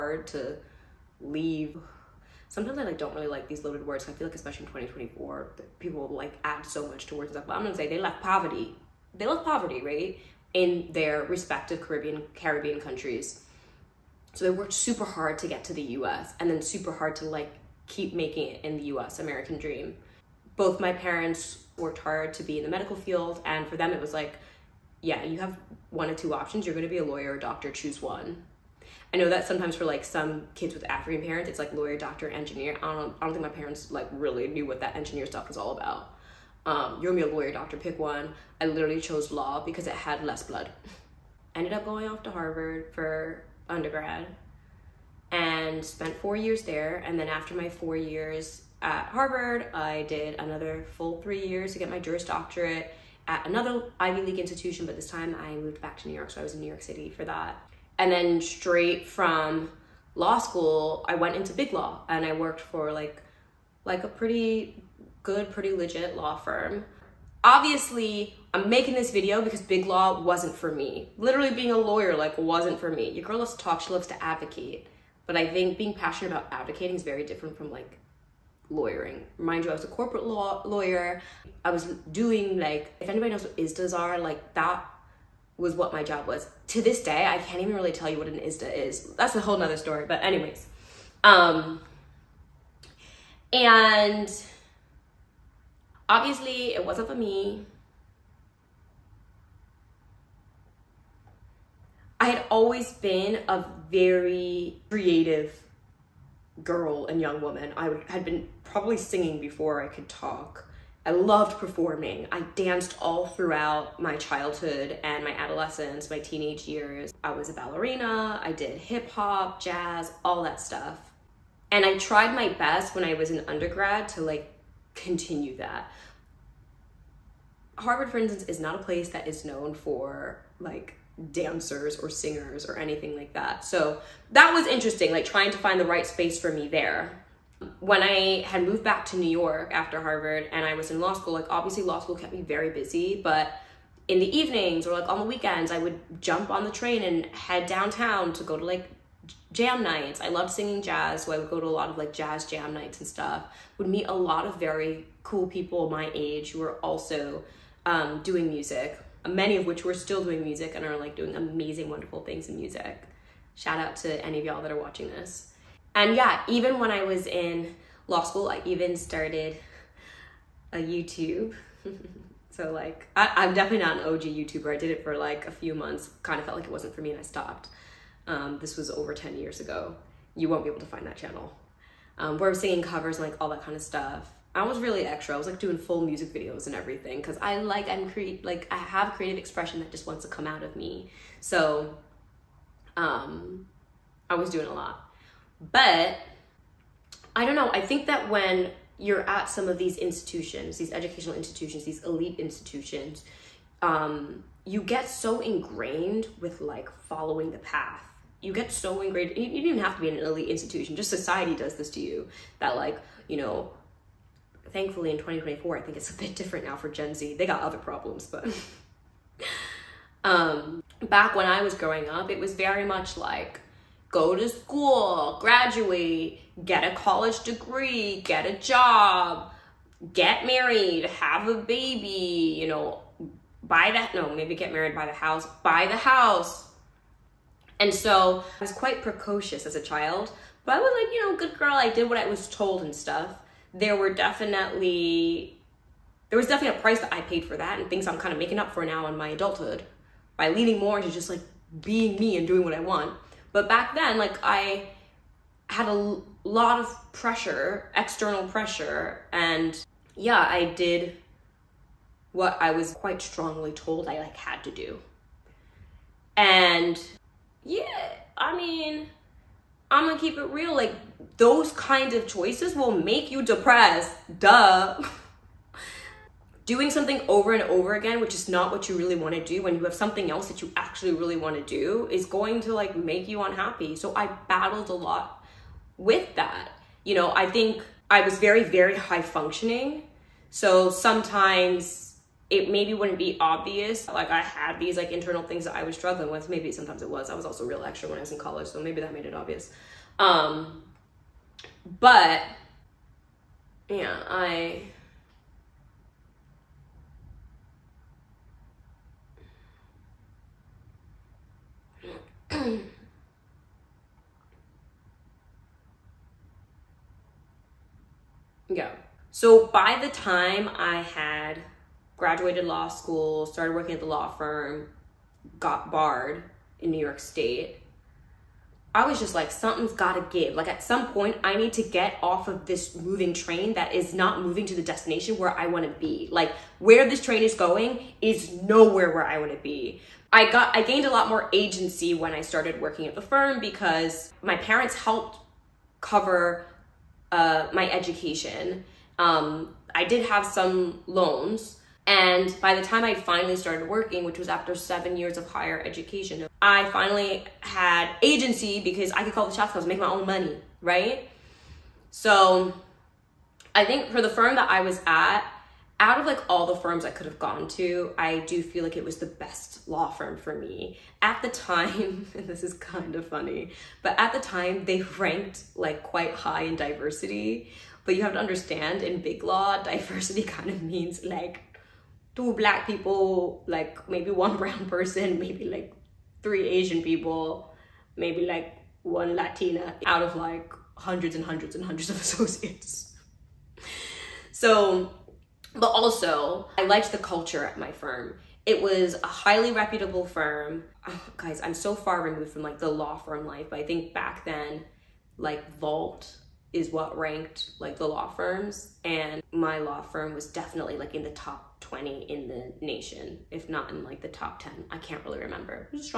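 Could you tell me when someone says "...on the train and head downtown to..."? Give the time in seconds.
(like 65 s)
146 s.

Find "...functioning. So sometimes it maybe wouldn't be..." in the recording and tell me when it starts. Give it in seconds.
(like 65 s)
289 s.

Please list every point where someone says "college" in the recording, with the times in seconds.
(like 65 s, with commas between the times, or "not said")
226 s, 298 s.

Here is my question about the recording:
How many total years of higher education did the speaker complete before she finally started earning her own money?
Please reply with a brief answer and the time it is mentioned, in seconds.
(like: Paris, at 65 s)
7, at 354 s.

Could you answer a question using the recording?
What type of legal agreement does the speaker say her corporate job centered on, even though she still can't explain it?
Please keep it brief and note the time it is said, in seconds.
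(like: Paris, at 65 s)
ISDAs, at 83 s.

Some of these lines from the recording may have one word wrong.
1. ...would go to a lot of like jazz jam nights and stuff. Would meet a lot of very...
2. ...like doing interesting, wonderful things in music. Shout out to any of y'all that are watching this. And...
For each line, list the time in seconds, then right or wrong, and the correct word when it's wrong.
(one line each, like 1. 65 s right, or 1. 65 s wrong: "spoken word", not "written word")
1. 151 s right
2. 160 s wrong: "amazing", not "interesting".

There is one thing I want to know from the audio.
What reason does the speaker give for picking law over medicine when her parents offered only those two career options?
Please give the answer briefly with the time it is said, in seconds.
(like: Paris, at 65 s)
less blood, at 40 s.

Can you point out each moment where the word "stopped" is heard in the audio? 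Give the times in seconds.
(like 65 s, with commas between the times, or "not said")
177 s.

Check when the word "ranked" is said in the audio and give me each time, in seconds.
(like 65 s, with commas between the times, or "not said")
375 s, 407 s.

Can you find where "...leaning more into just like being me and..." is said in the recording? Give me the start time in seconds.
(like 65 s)
250 s.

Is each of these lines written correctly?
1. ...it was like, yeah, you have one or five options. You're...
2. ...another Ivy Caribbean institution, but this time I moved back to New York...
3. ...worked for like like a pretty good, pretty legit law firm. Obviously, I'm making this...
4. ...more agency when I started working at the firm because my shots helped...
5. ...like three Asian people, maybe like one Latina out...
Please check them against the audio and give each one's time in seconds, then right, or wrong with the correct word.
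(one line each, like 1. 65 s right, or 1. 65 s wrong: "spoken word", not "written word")
1. 23 s wrong: "two", not "five"
2. 53 s wrong: "League", not "Caribbean"
3. 62 s right
4. 341 s wrong: "parents", not "shots"
5. 385 s right.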